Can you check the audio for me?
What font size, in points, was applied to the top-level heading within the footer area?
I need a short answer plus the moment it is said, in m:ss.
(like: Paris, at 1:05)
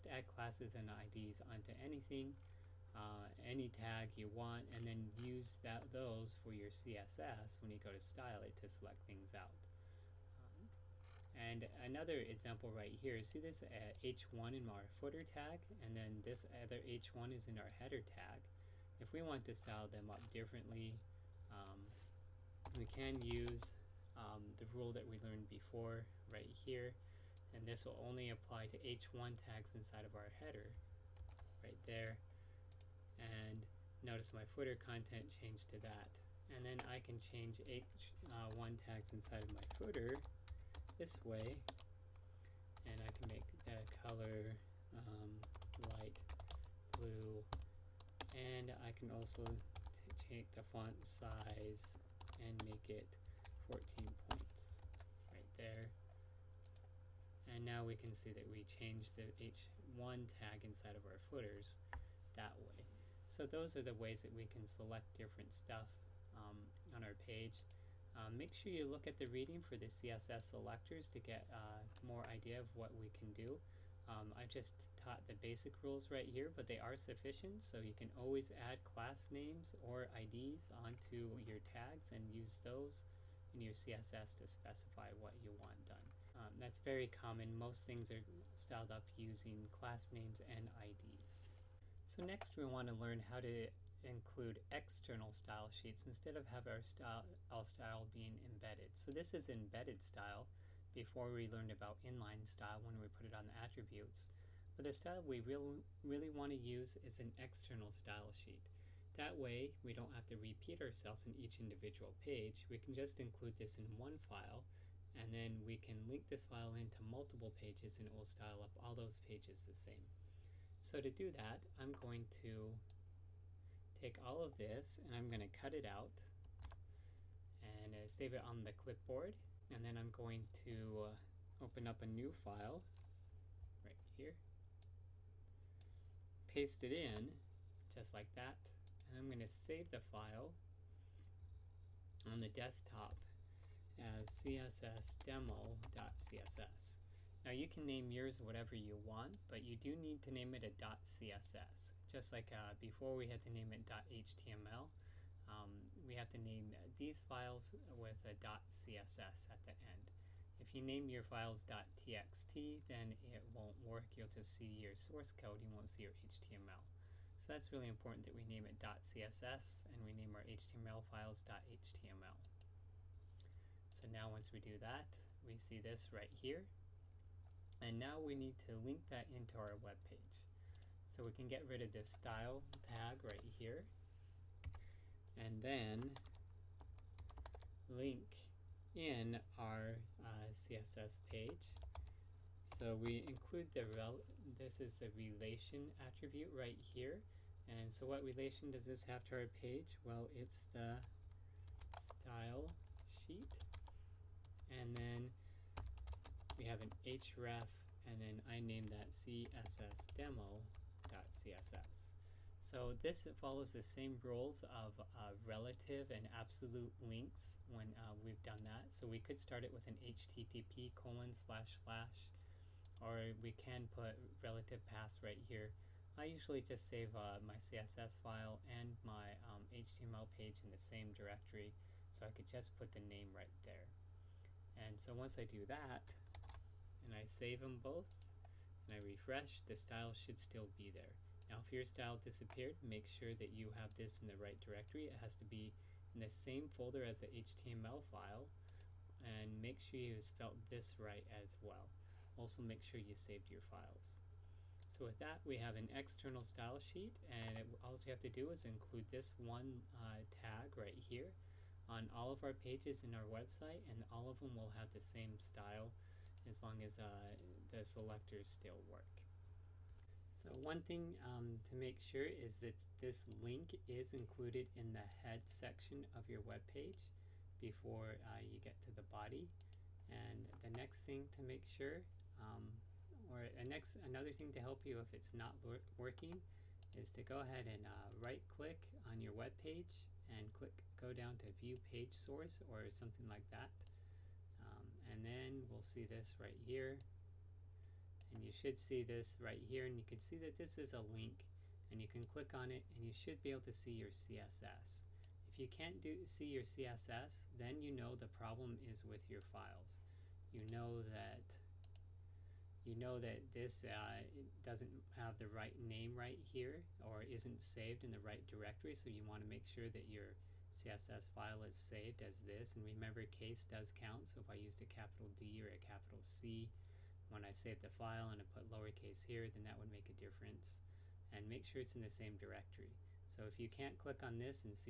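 14, at 0:53.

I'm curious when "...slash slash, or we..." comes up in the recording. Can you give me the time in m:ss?
3:41.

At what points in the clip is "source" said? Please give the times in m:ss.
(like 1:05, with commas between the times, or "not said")
2:44, 4:52.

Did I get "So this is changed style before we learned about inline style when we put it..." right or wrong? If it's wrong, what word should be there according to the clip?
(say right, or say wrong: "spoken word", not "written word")
wrong: "embedded", not "changed".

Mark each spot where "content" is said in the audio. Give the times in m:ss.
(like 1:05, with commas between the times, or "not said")
0:34.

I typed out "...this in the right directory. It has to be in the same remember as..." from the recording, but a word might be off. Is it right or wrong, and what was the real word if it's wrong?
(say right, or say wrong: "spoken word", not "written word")
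wrong: "folder", not "remember".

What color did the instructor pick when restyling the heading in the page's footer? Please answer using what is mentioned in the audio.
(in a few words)
light blue.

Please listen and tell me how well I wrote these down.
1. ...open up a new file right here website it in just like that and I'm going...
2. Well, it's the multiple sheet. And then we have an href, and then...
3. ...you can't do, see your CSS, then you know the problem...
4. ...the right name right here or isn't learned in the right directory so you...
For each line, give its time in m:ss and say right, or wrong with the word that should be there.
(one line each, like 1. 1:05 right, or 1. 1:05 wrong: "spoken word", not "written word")
1. 2:11 wrong: "paste", not "website"
2. 3:20 wrong: "style", not "multiple"
3. 5:05 right
4. 5:15 wrong: "saved", not "learned".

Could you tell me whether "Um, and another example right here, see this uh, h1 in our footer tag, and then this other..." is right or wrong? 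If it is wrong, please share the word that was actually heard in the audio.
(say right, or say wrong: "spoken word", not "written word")
right.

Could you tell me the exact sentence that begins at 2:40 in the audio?
If you name your files .txt, then it won't work.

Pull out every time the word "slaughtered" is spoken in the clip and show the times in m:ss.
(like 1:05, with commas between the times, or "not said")
not said.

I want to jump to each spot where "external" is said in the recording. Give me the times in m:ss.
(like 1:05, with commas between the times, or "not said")
1:34, 1:47, 4:15.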